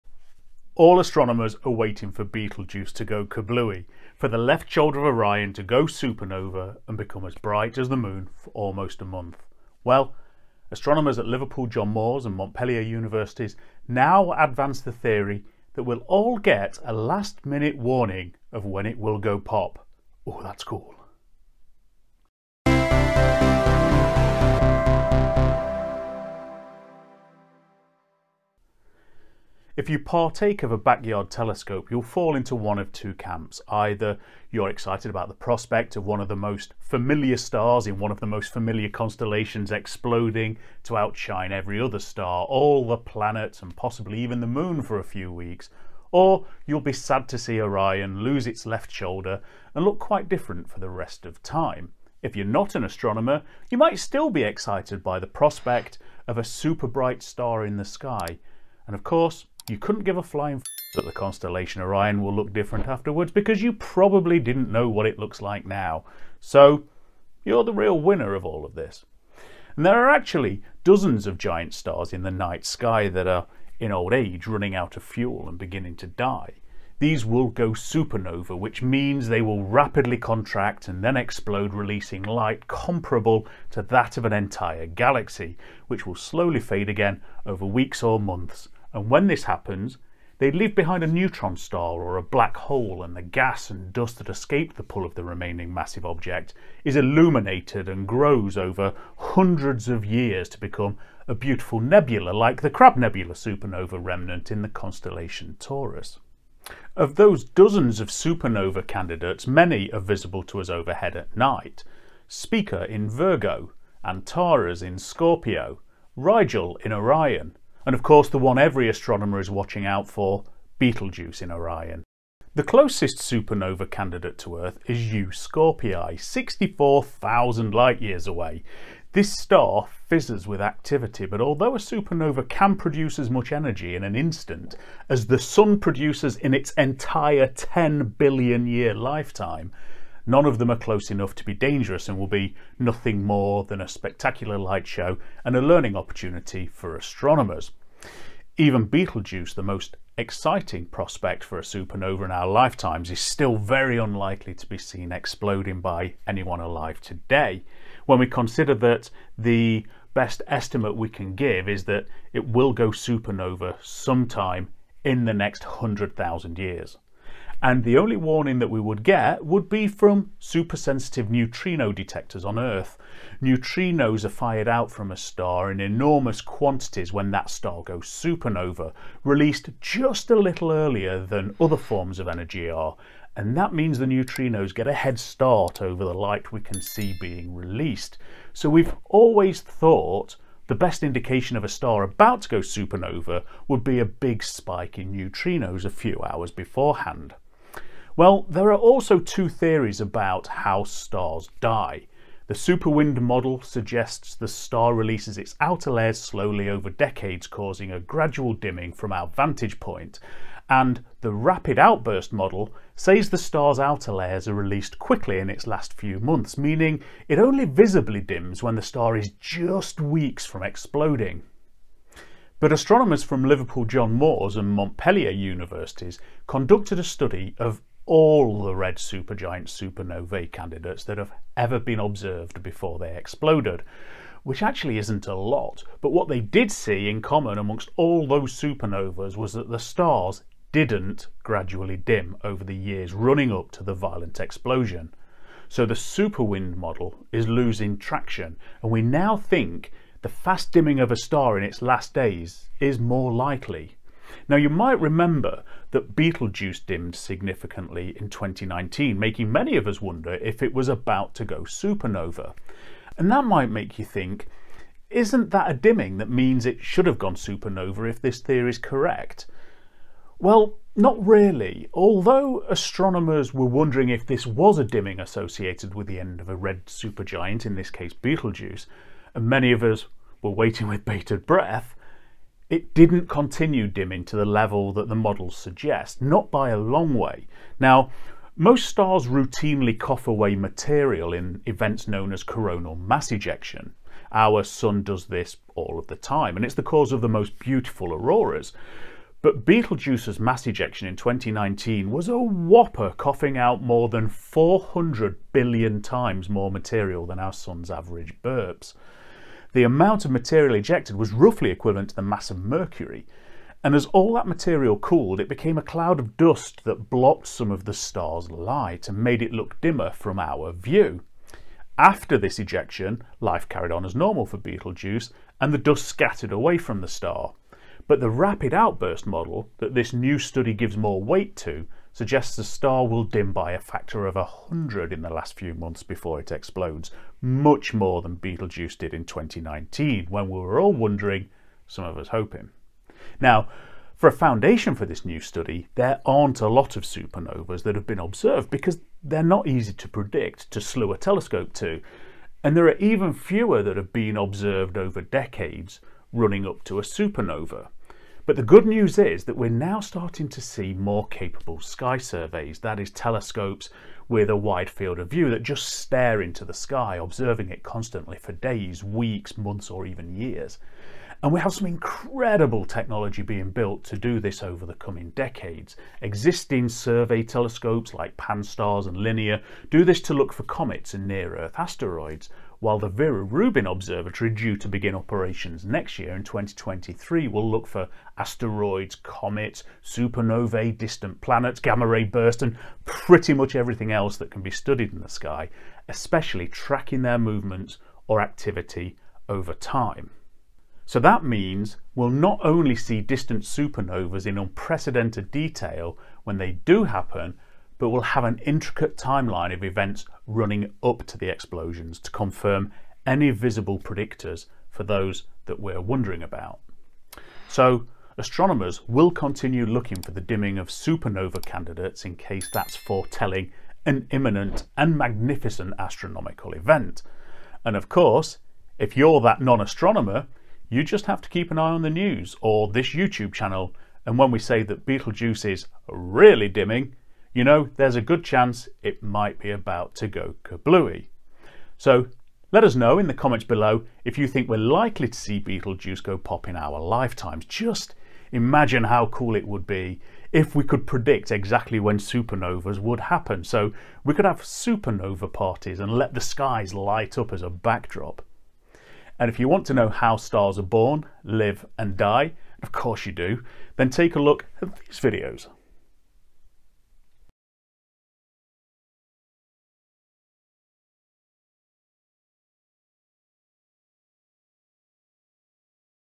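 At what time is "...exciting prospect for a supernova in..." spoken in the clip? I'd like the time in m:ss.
2:30.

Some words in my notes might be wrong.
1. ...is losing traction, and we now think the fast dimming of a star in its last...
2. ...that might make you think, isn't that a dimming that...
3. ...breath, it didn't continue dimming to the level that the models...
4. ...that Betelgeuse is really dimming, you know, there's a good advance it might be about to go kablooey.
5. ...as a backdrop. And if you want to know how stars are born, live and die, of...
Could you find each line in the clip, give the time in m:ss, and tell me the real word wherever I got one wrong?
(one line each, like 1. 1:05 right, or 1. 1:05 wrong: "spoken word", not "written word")
1. 4:07 right
2. 4:23 right
3. 4:41 right
4. 7:14 wrong: "chance", not "advance"
5. 7:37 right.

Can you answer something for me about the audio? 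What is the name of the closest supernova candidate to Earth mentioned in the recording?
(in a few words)
U Scorpii.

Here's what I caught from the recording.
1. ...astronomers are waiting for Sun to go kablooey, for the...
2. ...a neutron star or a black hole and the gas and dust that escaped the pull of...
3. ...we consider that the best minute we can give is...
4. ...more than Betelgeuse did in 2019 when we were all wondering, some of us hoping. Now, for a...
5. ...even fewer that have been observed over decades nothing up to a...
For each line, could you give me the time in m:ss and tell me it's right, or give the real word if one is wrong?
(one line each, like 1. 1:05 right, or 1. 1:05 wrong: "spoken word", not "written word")
1. 0:01 wrong: "Betelgeuse", not "Sun"
2. 1:31 right
3. 2:38 wrong: "estimate", not "minute"
4. 5:37 right
5. 5:52 wrong: "running", not "nothing".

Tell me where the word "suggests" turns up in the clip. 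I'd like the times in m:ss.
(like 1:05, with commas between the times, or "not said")
3:23, 4:45, 5:32.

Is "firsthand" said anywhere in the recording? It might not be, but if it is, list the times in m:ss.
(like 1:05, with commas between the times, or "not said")
not said.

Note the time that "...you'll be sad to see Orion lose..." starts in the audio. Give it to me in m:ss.
0:46.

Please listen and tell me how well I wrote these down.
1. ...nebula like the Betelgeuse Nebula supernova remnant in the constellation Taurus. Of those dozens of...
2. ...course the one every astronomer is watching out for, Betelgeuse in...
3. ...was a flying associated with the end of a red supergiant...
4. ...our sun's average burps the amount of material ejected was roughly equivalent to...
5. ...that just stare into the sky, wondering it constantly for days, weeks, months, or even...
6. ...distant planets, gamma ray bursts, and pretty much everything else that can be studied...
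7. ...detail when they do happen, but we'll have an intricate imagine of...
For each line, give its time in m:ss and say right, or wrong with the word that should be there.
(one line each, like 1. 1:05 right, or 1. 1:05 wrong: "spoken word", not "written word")
1. 1:41 wrong: "Crab", not "Betelgeuse"
2. 1:58 right
3. 4:34 wrong: "dimming", not "flying"
4. 5:07 right
5. 6:05 wrong: "observing", not "wondering"
6. 6:30 right
7. 6:45 wrong: "timeline", not "imagine".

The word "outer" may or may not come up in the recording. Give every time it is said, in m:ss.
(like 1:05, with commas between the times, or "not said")
3:25, 3:33.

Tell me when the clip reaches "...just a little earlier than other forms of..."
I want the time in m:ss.
2:59.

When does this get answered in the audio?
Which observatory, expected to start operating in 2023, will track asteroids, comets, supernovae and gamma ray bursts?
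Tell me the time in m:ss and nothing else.
6:23.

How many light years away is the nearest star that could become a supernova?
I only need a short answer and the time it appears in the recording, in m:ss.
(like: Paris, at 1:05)
64,000 light years, at 2:06.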